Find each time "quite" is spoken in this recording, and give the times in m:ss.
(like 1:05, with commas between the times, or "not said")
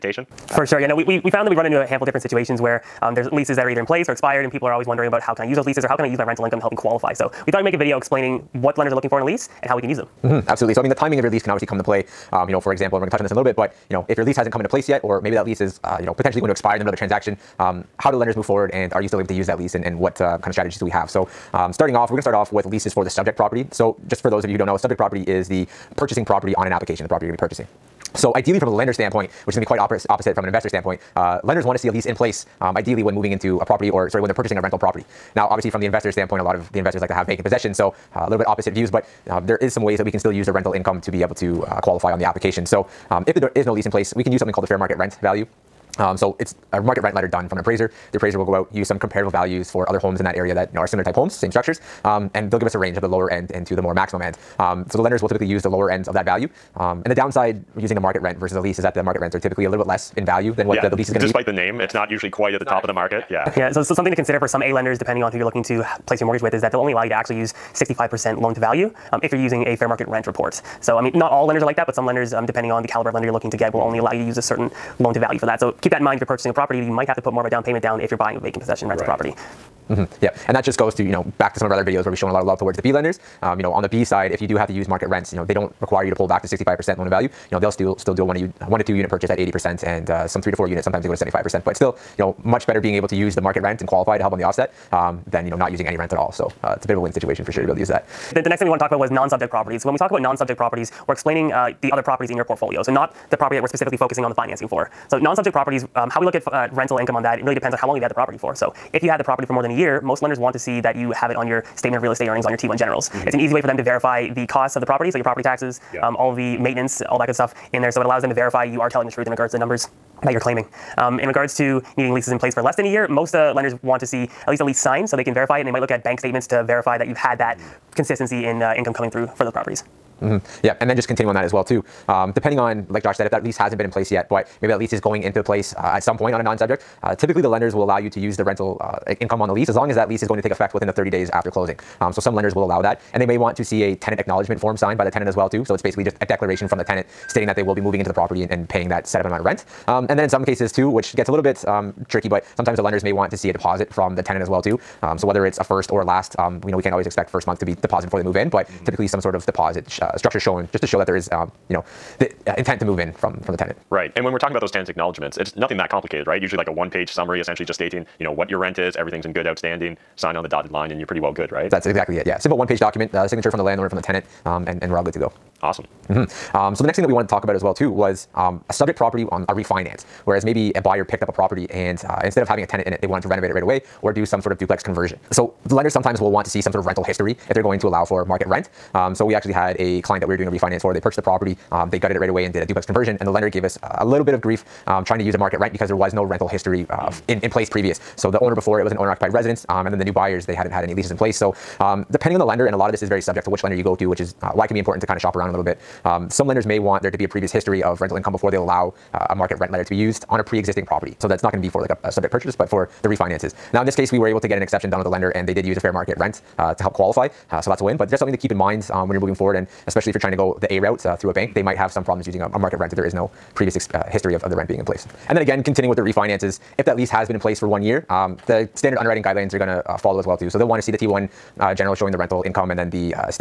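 0:29, 1:02.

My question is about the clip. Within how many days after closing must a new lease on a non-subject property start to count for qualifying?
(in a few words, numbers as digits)
30.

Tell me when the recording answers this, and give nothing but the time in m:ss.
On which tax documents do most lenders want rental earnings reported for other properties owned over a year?
1:52.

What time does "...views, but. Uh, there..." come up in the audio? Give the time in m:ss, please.
0:38.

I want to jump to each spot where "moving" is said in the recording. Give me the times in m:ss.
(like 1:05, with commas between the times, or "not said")
0:33, 2:27, 3:39.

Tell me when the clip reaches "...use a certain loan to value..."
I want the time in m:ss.
1:14.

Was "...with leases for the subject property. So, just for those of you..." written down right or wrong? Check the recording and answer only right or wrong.
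right.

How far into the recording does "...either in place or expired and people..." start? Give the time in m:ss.
0:03.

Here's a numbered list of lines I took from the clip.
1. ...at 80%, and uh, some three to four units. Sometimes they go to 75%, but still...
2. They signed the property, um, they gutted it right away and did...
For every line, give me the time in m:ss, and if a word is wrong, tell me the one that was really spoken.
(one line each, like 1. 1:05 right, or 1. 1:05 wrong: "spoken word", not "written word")
1. 1:29 right
2. 3:10 wrong: "purchased", not "signed".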